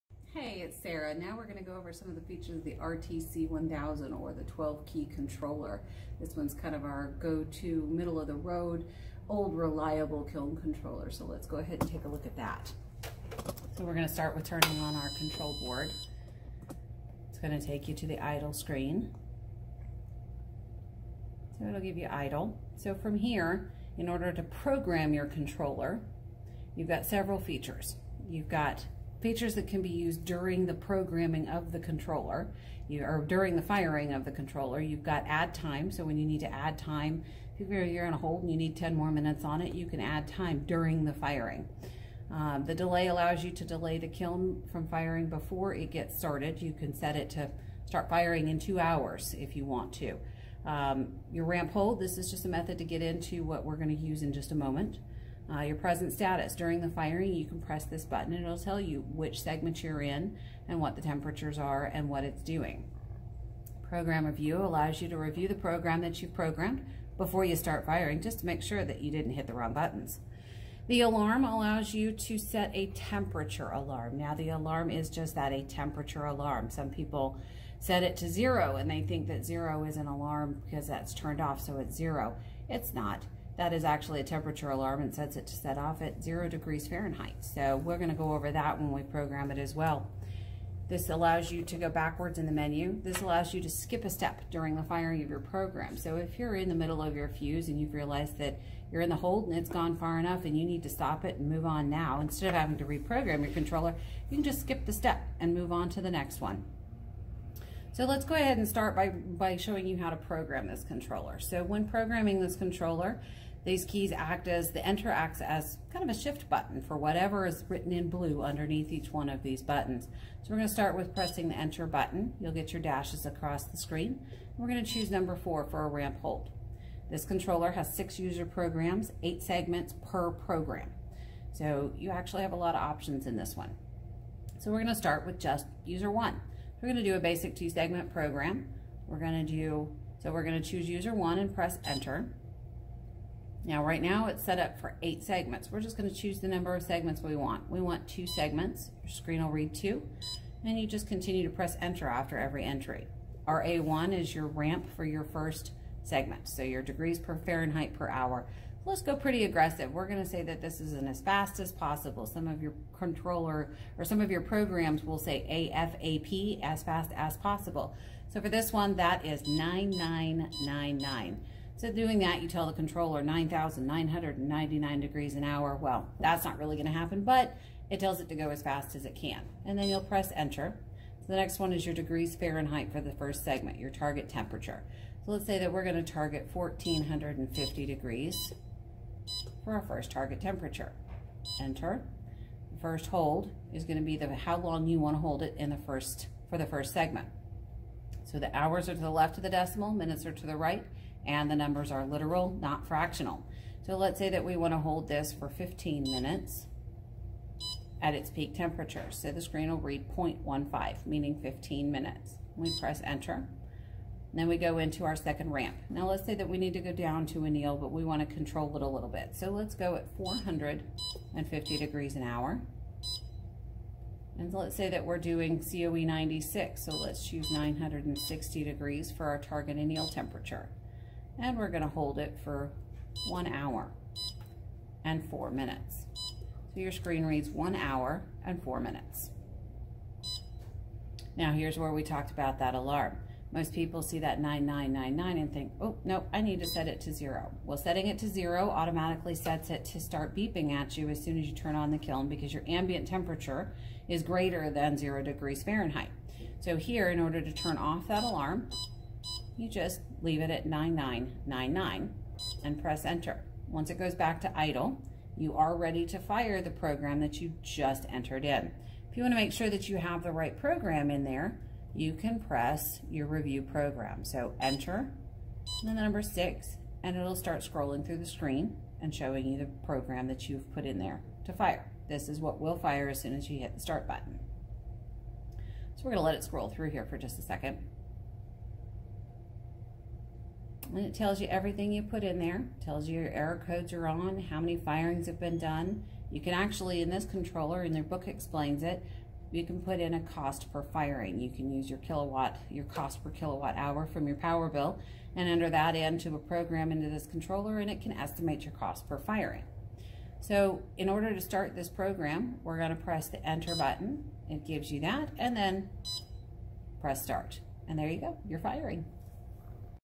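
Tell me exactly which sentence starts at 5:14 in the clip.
It gives you that and then press start.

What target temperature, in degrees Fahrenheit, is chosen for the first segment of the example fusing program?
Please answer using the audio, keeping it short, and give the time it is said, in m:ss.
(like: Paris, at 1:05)
1450, at 3:06.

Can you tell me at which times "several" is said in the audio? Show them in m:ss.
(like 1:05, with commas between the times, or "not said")
0:27.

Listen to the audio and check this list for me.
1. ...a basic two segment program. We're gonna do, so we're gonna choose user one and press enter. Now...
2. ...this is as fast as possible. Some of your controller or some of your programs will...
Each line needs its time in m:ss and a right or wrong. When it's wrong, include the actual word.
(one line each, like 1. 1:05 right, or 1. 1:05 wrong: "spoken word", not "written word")
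1. 2:17 right
2. 2:40 right.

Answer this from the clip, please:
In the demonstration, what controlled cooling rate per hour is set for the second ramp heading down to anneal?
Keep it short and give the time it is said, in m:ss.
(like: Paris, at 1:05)
450 degrees an hour, at 3:40.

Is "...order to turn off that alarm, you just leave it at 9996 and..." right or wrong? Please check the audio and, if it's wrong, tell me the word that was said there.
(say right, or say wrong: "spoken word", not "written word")
wrong: "9999", not "9996".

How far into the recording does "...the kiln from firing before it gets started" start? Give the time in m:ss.
0:43.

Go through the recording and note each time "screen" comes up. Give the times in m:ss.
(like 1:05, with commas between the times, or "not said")
0:18, 2:03, 2:29, 3:29, 3:56, 4:38.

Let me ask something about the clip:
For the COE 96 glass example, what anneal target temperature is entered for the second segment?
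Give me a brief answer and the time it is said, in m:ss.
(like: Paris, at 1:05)
960 degrees, at 3:47.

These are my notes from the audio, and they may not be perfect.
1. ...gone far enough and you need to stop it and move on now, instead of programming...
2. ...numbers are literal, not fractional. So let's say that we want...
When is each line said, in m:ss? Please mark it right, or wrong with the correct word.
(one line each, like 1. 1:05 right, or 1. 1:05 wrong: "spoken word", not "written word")
1. 1:39 wrong: "having", not "programming"
2. 3:21 right.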